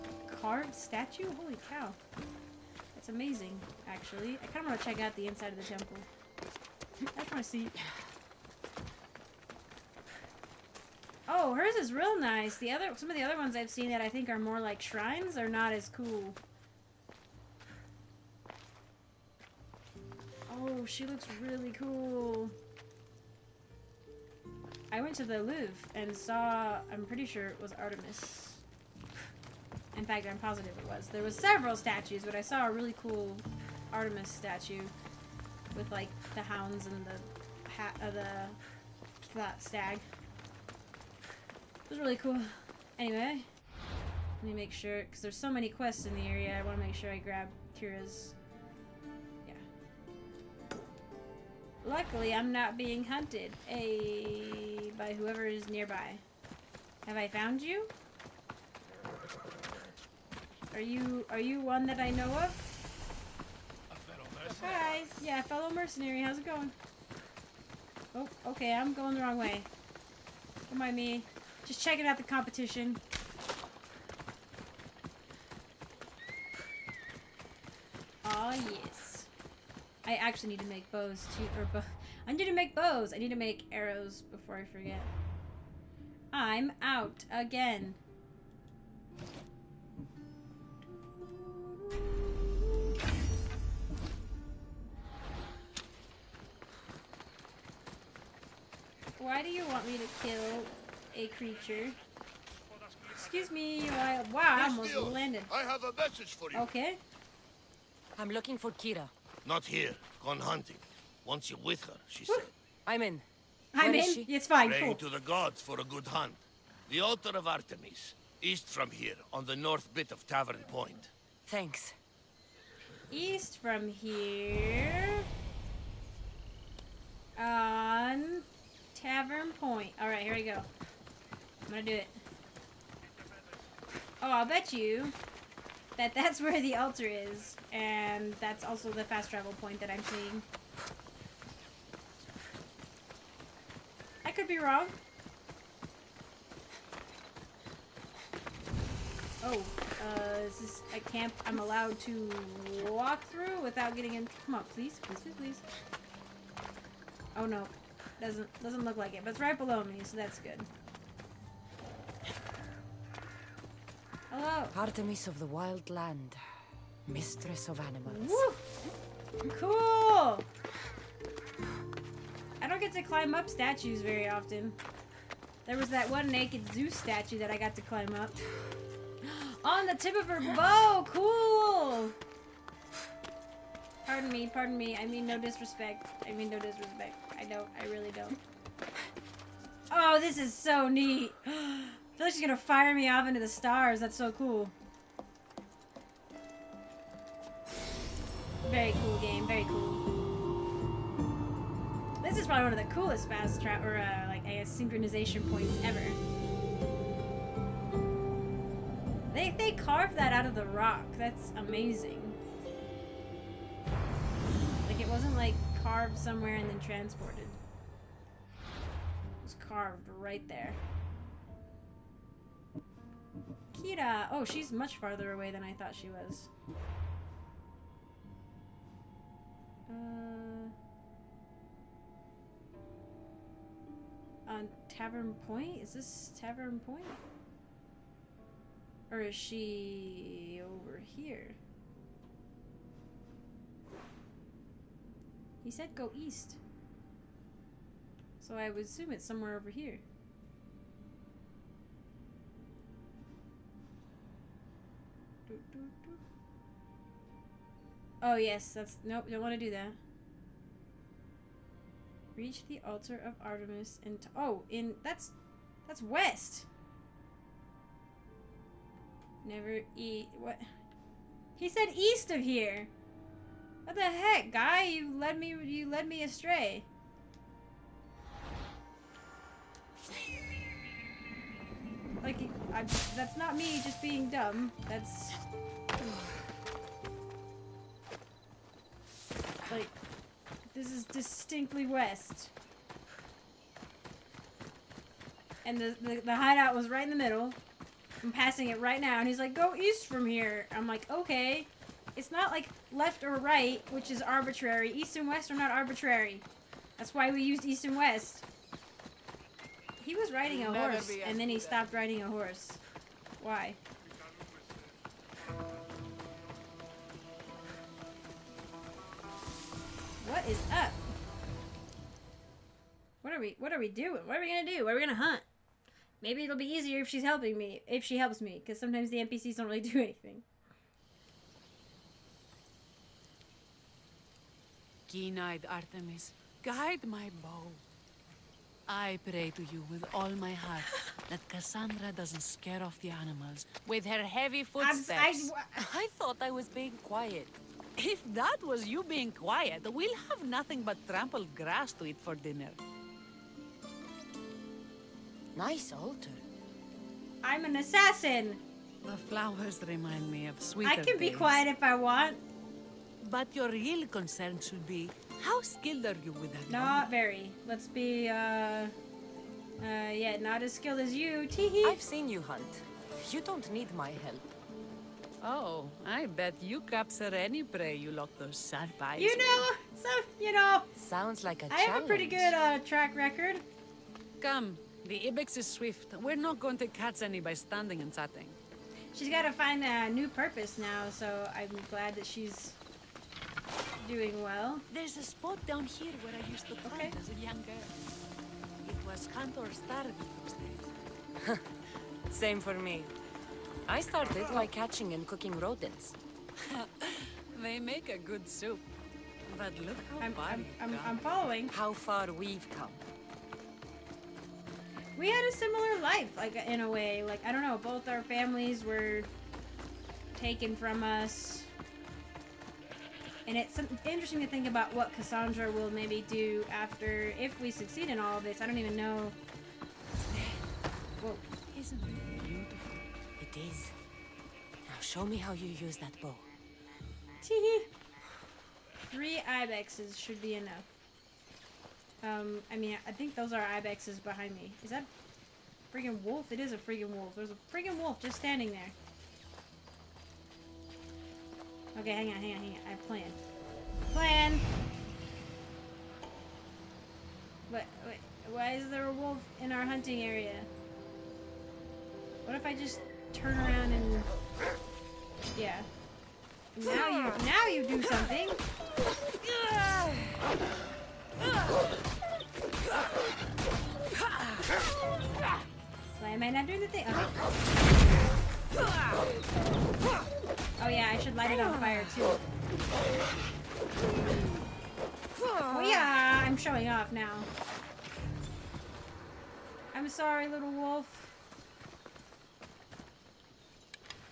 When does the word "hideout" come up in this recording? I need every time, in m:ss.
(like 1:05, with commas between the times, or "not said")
4:56.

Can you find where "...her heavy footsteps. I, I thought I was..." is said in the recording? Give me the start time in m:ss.
5:44.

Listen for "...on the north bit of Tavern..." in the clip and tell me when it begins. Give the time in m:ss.
1:59.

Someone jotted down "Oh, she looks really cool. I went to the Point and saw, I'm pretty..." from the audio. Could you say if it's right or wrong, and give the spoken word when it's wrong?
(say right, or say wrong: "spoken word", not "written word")
wrong: "Louvre", not "Point".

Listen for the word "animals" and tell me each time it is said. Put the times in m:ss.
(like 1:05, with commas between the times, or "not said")
2:47, 5:43.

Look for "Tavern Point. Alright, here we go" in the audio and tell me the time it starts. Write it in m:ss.
2:09.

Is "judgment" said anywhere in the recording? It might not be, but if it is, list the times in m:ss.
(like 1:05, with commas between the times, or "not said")
not said.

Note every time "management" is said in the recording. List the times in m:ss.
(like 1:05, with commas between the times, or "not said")
not said.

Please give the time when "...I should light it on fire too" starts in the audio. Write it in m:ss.
8:01.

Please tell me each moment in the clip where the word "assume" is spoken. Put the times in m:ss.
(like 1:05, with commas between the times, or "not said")
4:08.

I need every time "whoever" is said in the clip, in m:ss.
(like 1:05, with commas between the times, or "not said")
0:55.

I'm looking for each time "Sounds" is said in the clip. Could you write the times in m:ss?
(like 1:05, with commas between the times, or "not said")
6:20.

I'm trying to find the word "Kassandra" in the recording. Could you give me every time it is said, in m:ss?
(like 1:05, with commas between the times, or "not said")
5:41, 7:05.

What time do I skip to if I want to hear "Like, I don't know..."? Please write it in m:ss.
6:57.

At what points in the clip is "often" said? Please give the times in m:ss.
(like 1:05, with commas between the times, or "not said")
2:54.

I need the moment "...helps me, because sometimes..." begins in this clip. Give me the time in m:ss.
5:28.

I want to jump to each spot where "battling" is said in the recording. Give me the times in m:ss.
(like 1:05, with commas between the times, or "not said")
not said.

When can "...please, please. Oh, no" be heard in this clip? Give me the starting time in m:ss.
2:35.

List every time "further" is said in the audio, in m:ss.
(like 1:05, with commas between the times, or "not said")
not said.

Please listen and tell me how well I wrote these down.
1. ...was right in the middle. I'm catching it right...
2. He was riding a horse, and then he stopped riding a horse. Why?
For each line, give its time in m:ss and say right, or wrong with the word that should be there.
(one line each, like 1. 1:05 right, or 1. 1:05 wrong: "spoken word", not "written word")
1. 4:56 wrong: "passing", not "catching"
2. 5:10 right.